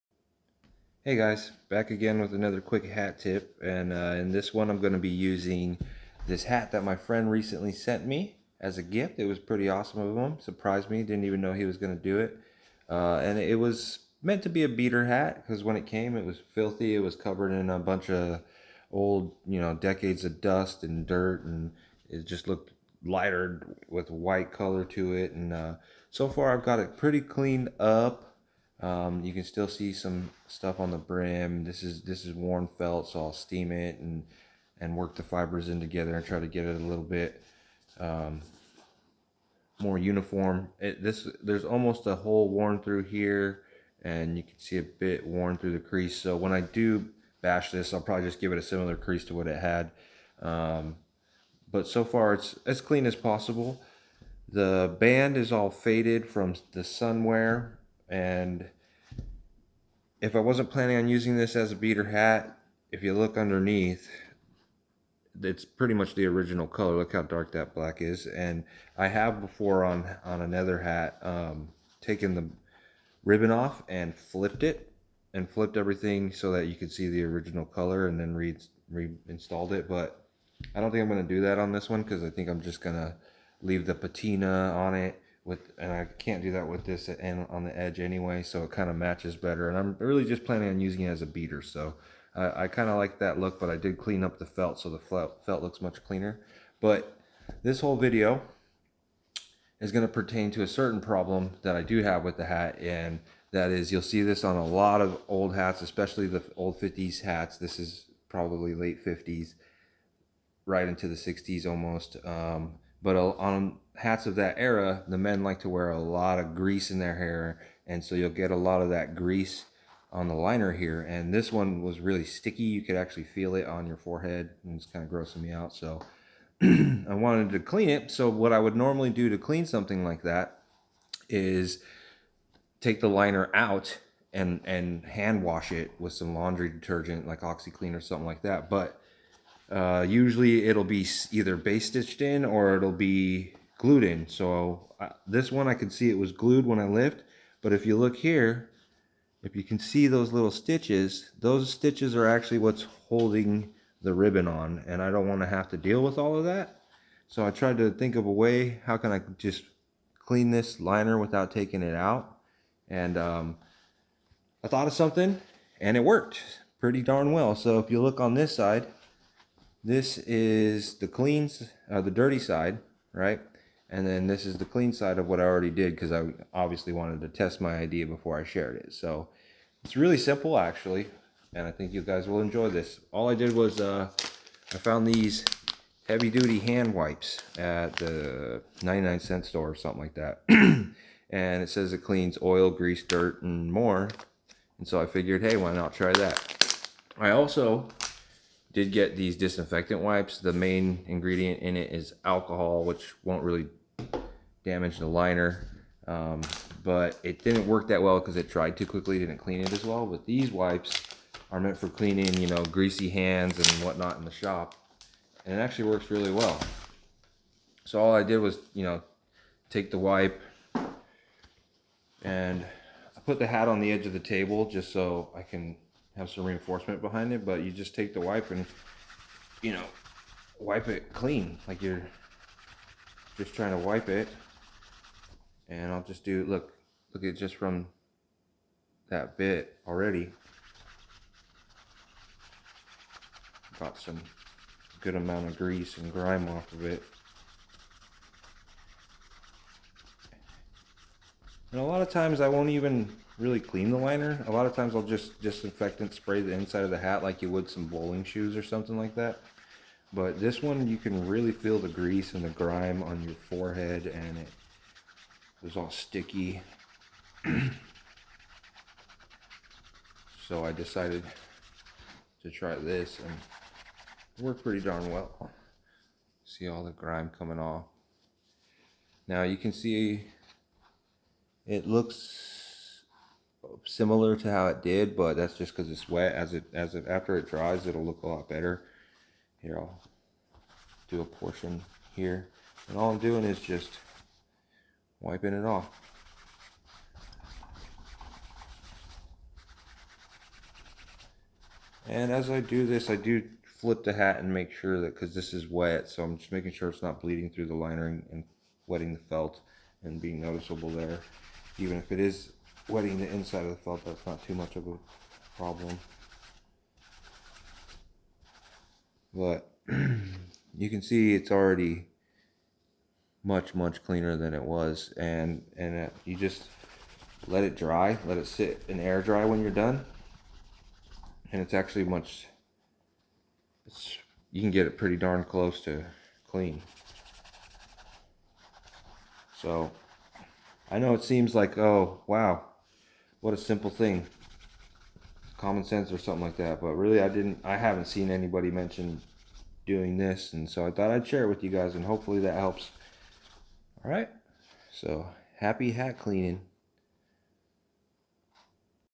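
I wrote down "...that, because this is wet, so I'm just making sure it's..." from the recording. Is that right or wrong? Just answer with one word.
right.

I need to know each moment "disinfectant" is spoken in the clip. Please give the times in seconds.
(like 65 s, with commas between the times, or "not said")
199 s, 255 s.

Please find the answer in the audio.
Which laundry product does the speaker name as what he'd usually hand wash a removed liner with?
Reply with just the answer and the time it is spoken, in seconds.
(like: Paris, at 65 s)
OxyClean, at 137 s.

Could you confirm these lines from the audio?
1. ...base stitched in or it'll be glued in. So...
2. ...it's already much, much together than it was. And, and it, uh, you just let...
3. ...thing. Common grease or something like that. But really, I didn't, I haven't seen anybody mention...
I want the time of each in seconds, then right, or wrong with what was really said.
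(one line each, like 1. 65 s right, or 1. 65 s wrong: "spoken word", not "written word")
1. 141 s right
2. 321 s wrong: "cleaner", not "together"
3. 343 s wrong: "sense", not "grease".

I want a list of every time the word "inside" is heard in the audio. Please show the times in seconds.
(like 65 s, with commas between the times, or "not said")
256 s, 313 s.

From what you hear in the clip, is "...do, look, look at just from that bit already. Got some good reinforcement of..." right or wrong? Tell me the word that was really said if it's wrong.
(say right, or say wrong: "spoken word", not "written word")
wrong: "amount", not "reinforcement".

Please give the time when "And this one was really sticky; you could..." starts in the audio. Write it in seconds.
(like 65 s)
121 s.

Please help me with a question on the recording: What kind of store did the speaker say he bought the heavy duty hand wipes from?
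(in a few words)
99 cent store.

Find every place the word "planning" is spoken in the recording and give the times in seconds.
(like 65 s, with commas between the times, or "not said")
60 s, 90 s.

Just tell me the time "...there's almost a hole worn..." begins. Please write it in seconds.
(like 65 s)
41 s.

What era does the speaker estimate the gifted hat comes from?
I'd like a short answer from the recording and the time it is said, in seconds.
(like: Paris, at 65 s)
late 50s, at 108 s.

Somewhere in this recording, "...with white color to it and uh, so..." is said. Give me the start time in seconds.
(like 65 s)
23 s.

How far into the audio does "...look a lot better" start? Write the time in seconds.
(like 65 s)
288 s.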